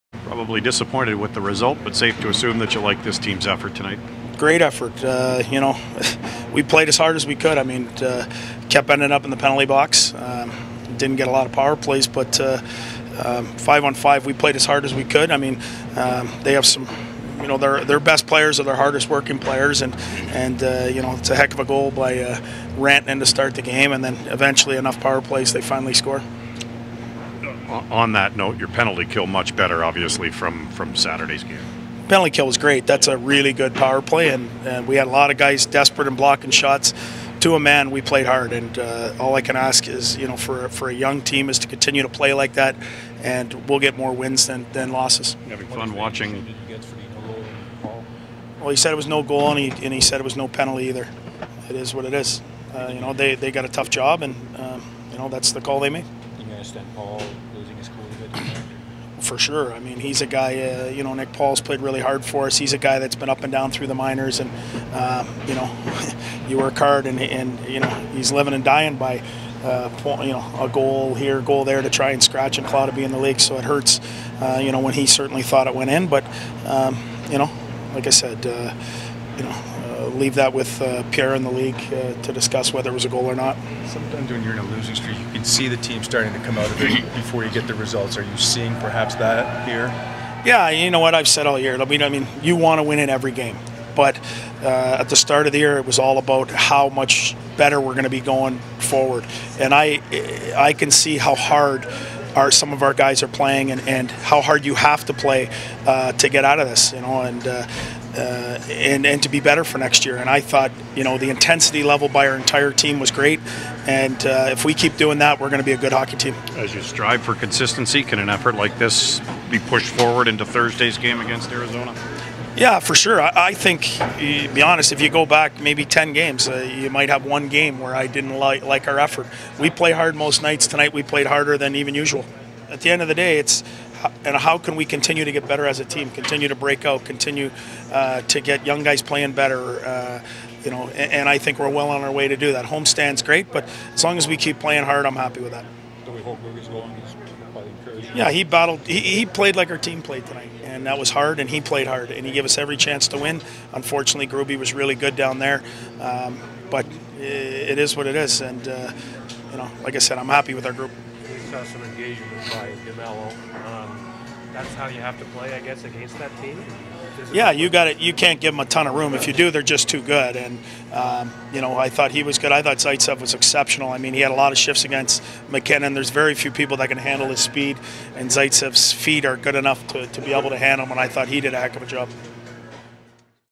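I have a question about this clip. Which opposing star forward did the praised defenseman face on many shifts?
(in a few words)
MacKinnon.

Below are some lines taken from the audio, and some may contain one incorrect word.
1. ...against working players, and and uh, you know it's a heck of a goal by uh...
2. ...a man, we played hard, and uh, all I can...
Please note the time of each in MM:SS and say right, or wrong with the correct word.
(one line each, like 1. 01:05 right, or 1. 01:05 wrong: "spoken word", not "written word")
1. 00:18 wrong: "hardest", not "against"
2. 00:37 right.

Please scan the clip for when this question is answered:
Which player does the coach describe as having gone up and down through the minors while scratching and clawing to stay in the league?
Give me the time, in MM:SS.
01:01.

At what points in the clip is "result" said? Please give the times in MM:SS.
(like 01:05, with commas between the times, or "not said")
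00:01, 01:27.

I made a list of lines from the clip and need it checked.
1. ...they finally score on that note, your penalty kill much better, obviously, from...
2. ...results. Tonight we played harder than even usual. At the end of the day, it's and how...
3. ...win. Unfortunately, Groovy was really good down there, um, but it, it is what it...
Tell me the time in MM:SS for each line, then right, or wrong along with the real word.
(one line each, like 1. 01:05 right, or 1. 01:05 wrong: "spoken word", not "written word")
1. 00:25 right
2. 02:10 wrong: "nights", not "results"
3. 02:33 right.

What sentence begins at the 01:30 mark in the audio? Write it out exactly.
Yeah, you know what I've said all year.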